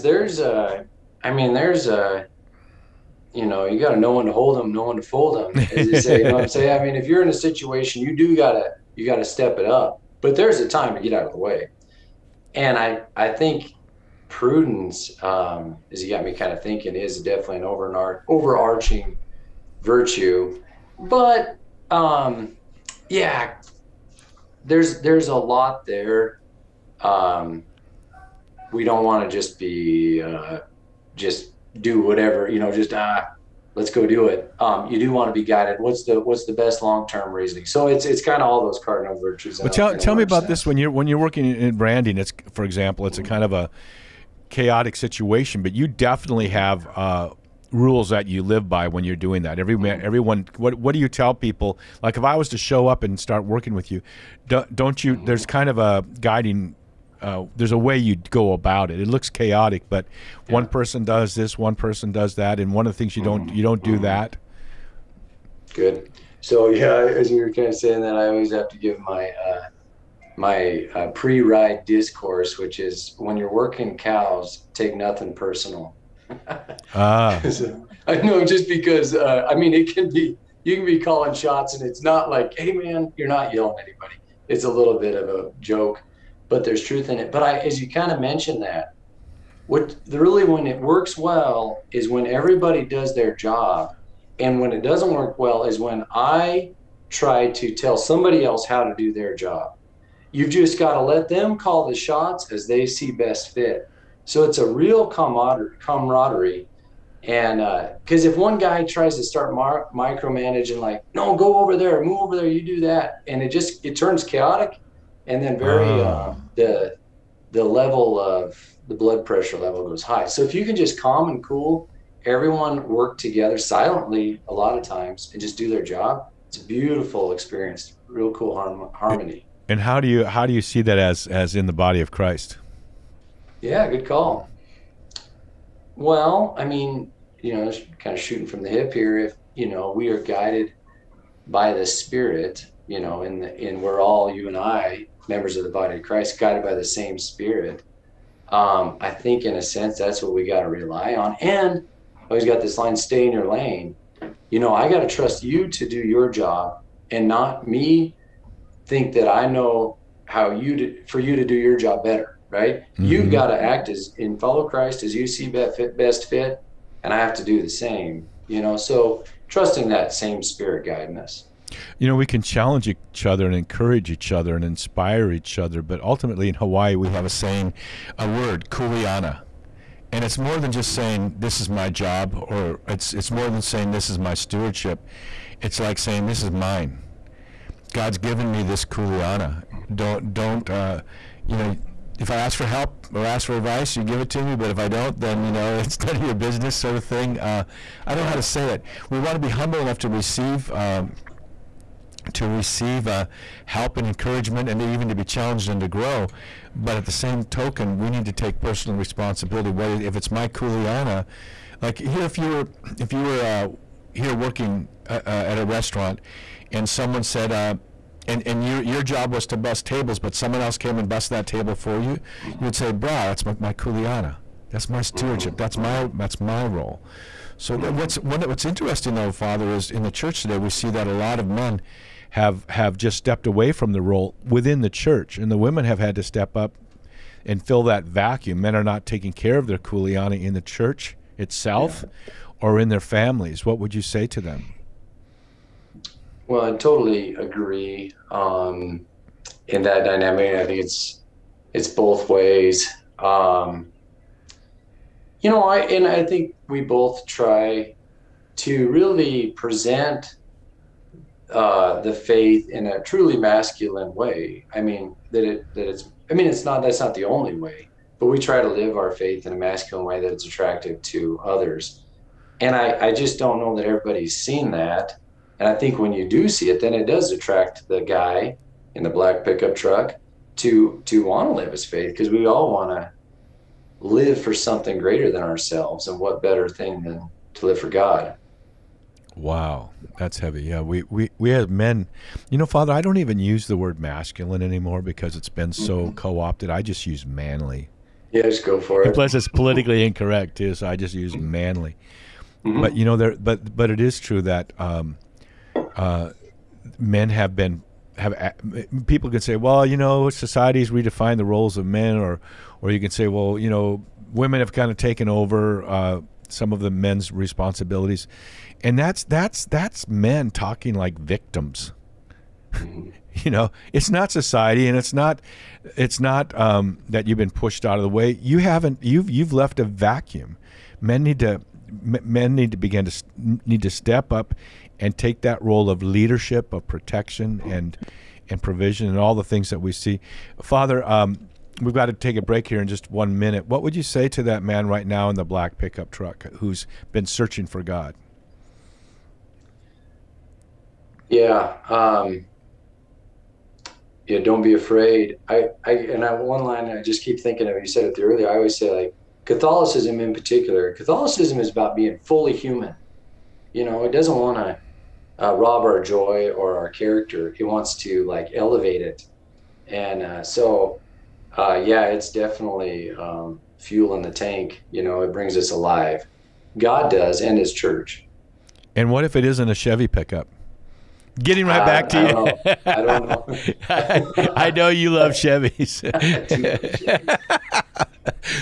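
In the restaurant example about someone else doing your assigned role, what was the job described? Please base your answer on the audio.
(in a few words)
Bust tables.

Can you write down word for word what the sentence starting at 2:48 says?
You know, so trusting that same spirit guiding us.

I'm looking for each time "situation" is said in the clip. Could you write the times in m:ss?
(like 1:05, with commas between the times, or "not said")
0:07, 0:44.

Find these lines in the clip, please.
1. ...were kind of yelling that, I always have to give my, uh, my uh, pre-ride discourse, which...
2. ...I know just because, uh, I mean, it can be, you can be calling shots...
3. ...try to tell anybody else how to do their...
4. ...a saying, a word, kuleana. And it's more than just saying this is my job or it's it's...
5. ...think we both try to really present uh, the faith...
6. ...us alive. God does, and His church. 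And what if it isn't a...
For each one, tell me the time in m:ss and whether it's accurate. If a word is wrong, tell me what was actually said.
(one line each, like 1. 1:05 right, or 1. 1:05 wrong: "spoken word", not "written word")
1. 1:07 wrong: "saying", not "yelling"
2. 1:18 right
3. 1:37 wrong: "somebody", not "anybody"
4. 2:57 right
5. 4:16 right
6. 6:15 right.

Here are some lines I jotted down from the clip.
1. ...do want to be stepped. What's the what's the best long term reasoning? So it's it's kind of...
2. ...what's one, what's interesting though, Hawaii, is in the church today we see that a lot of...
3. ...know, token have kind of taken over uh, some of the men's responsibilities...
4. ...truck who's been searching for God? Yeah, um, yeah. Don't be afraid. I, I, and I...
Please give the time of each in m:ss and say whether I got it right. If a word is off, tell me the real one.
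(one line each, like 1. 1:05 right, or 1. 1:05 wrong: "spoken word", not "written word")
1. 0:34 wrong: "guided", not "stepped"
2. 3:47 wrong: "Father", not "Hawaii"
3. 5:13 wrong: "women", not "token"
4. 5:46 right.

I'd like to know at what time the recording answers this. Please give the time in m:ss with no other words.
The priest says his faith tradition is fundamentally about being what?
6:02.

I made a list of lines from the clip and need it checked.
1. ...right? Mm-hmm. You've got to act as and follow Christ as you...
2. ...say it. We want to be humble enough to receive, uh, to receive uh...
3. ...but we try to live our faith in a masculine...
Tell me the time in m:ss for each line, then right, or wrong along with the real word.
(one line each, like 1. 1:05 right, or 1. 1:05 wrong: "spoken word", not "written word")
1. 2:42 right
2. 3:18 right
3. 4:28 right.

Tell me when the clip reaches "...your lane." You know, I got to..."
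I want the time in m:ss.
2:33.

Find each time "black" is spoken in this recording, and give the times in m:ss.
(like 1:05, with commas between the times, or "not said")
4:39, 5:45.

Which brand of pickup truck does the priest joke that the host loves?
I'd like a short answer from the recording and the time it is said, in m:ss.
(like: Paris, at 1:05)
Chevy, at 6:25.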